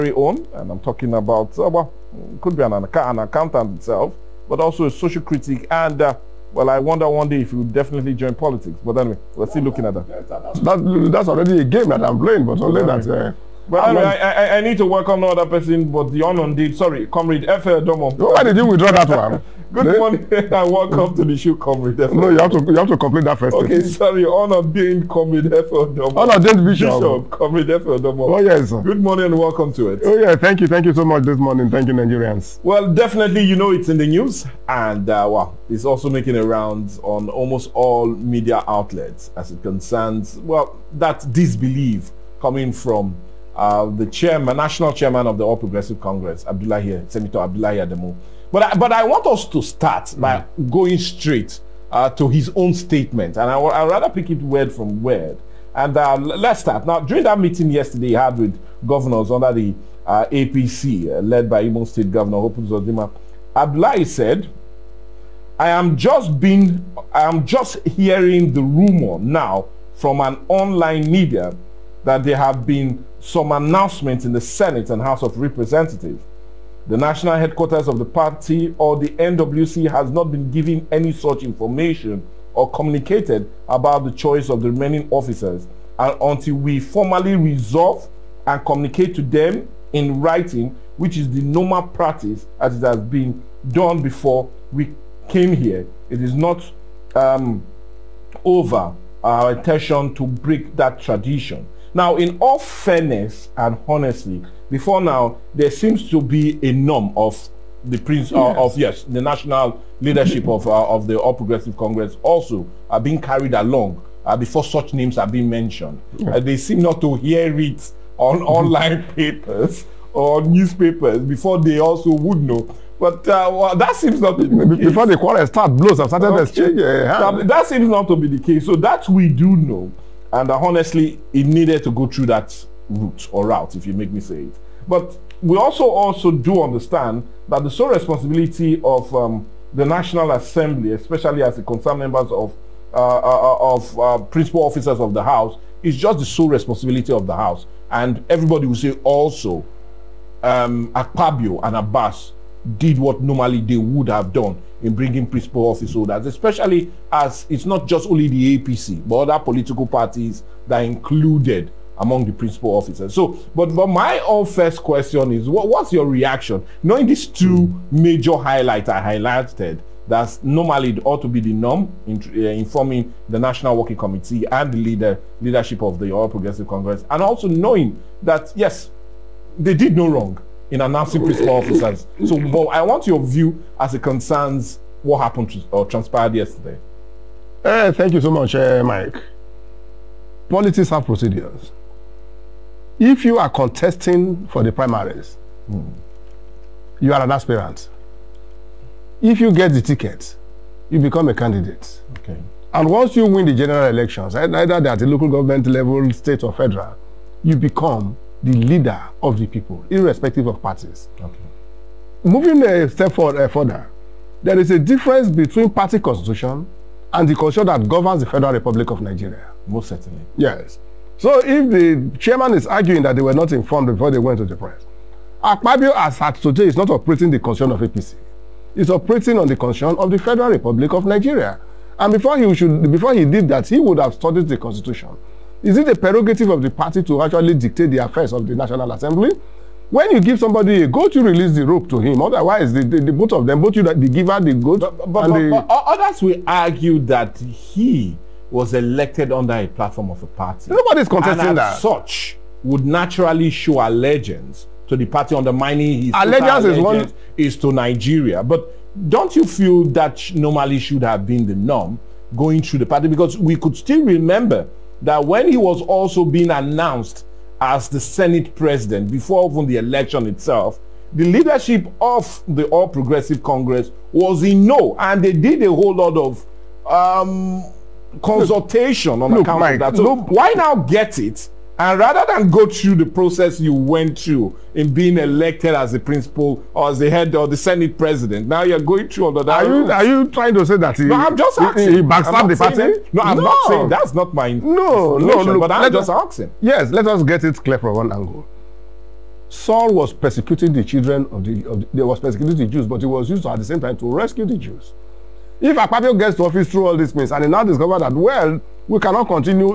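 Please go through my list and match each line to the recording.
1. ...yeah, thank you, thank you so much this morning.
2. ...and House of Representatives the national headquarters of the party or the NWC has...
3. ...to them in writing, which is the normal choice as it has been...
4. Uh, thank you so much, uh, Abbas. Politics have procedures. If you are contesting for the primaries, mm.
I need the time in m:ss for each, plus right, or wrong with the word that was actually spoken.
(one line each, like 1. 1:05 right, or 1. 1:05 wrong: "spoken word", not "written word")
1. 0:30 right
2. 1:14 right
3. 1:29 wrong: "practice", not "choice"
4. 3:07 wrong: "Mike", not "Abbas".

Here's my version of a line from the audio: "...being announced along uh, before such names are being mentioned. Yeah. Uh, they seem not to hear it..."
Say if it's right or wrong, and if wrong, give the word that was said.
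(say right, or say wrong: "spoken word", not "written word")
wrong: "carried", not "announced".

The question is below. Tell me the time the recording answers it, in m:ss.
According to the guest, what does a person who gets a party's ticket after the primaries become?
3:21.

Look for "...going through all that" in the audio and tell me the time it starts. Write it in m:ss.
4:48.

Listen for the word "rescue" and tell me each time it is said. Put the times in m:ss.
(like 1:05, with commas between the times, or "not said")
5:04.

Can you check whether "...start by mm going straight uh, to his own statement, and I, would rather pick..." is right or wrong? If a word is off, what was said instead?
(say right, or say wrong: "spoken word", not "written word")
right.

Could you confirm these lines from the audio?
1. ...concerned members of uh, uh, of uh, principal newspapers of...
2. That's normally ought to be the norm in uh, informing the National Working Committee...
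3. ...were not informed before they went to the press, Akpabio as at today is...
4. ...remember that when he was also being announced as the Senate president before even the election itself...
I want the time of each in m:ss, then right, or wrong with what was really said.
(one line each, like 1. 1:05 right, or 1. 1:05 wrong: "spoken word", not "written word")
1. 2:21 wrong: "officers", not "newspapers"
2. 2:50 right
3. 3:43 right
4. 4:24 right.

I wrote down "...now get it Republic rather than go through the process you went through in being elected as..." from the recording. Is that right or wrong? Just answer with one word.
wrong.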